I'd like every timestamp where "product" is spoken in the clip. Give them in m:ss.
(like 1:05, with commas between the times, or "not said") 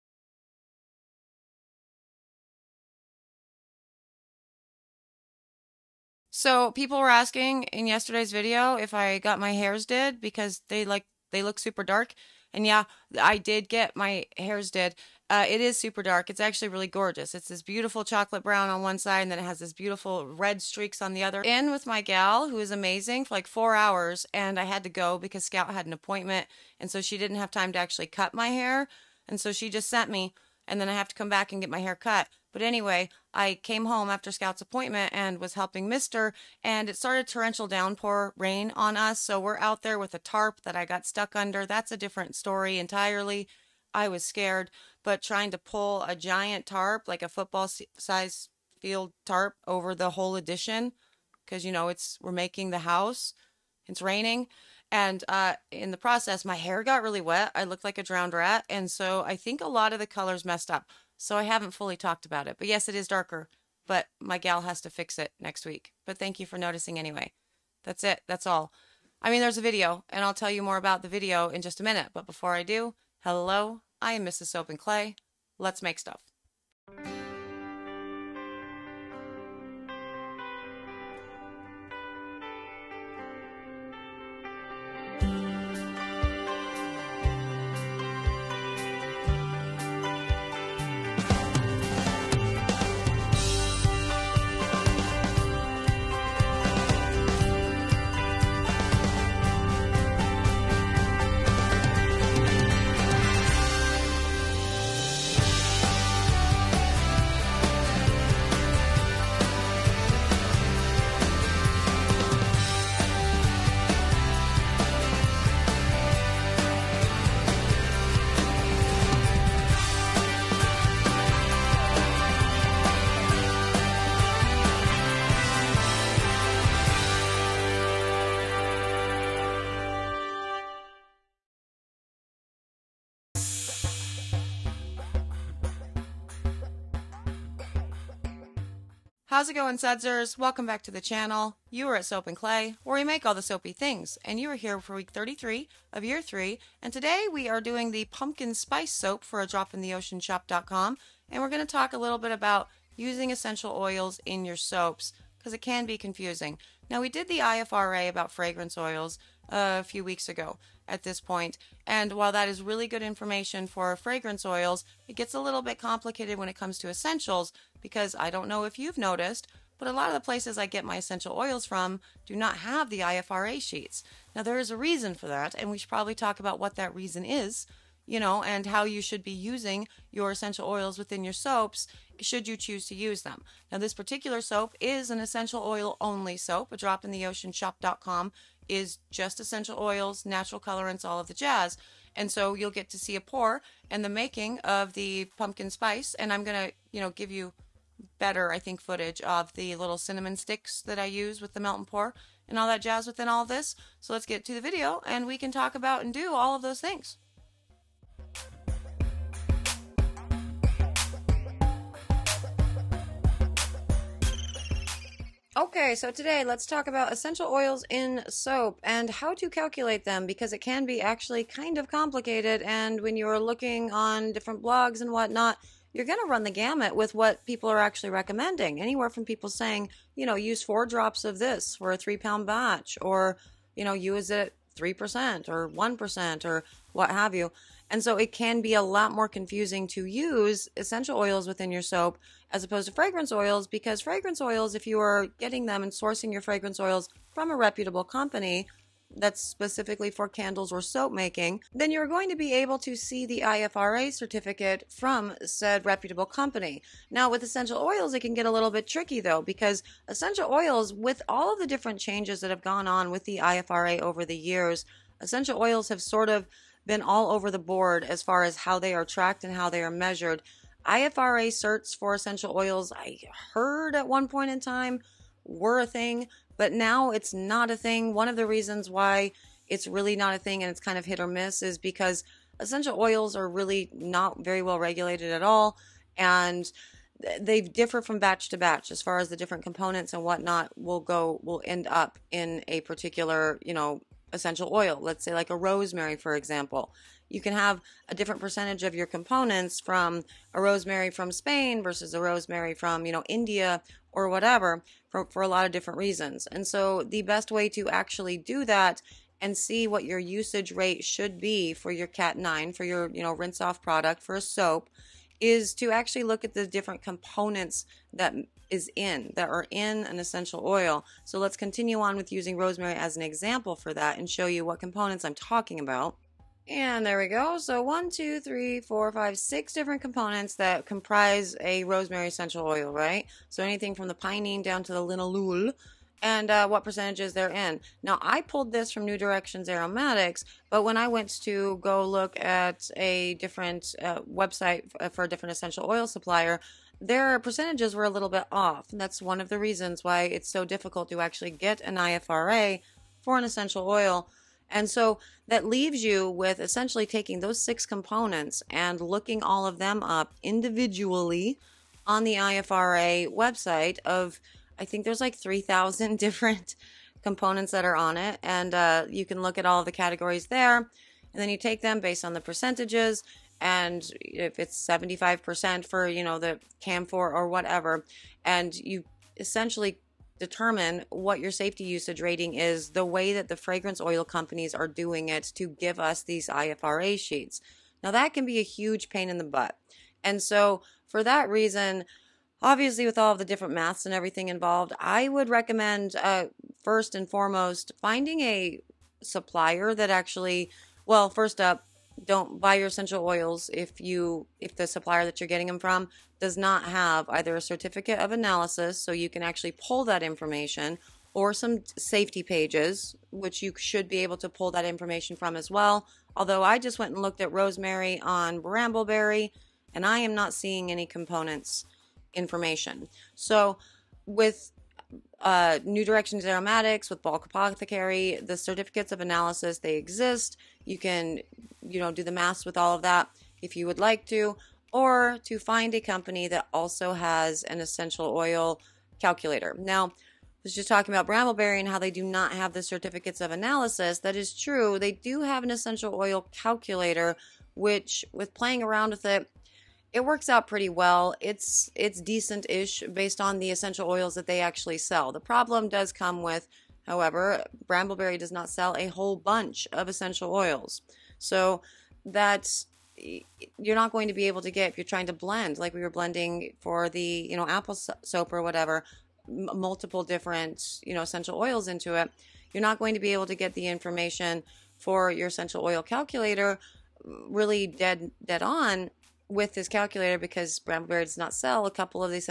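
5:13.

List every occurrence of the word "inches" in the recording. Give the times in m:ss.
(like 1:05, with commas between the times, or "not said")
not said.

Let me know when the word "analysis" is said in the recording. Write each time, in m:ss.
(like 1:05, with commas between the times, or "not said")
6:48, 7:09, 7:23.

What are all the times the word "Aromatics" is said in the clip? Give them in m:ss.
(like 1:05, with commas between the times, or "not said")
5:39, 7:06.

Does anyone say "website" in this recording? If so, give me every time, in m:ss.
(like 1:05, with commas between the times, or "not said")
5:44, 6:03.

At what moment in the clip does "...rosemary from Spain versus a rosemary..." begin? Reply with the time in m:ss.
5:00.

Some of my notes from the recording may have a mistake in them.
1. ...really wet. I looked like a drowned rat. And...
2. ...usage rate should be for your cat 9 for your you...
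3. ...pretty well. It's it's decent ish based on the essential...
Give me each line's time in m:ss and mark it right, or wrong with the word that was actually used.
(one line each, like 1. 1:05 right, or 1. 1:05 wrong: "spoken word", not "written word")
1. 0:57 right
2. 5:10 right
3. 7:30 right.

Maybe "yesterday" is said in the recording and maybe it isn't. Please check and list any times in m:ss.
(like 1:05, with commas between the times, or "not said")
0:07.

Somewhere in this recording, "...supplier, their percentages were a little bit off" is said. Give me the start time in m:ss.
5:46.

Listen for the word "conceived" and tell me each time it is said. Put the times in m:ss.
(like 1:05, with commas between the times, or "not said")
not said.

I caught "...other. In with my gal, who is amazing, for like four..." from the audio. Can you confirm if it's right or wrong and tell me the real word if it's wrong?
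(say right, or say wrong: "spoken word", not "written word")
right.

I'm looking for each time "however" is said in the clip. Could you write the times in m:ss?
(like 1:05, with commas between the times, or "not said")
7:37.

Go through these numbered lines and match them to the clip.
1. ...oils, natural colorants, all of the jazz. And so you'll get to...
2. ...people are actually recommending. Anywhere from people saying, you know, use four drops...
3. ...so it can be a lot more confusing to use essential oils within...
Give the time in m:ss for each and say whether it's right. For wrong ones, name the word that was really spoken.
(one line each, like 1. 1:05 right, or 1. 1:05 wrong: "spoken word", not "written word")
1. 3:09 right
2. 3:47 right
3. 3:58 right.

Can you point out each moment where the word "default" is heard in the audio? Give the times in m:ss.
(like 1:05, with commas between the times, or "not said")
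not said.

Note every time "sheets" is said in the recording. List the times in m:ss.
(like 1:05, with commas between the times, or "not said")
2:53, 6:27.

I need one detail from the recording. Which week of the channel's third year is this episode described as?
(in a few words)
33.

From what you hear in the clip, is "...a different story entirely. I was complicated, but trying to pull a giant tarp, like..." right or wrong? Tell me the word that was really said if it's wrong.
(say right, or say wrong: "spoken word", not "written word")
wrong: "scared", not "complicated".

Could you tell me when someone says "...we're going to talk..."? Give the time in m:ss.
2:31.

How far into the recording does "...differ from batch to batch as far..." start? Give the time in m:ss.
4:47.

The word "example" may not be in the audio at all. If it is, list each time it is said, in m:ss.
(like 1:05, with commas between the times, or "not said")
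4:56, 5:23.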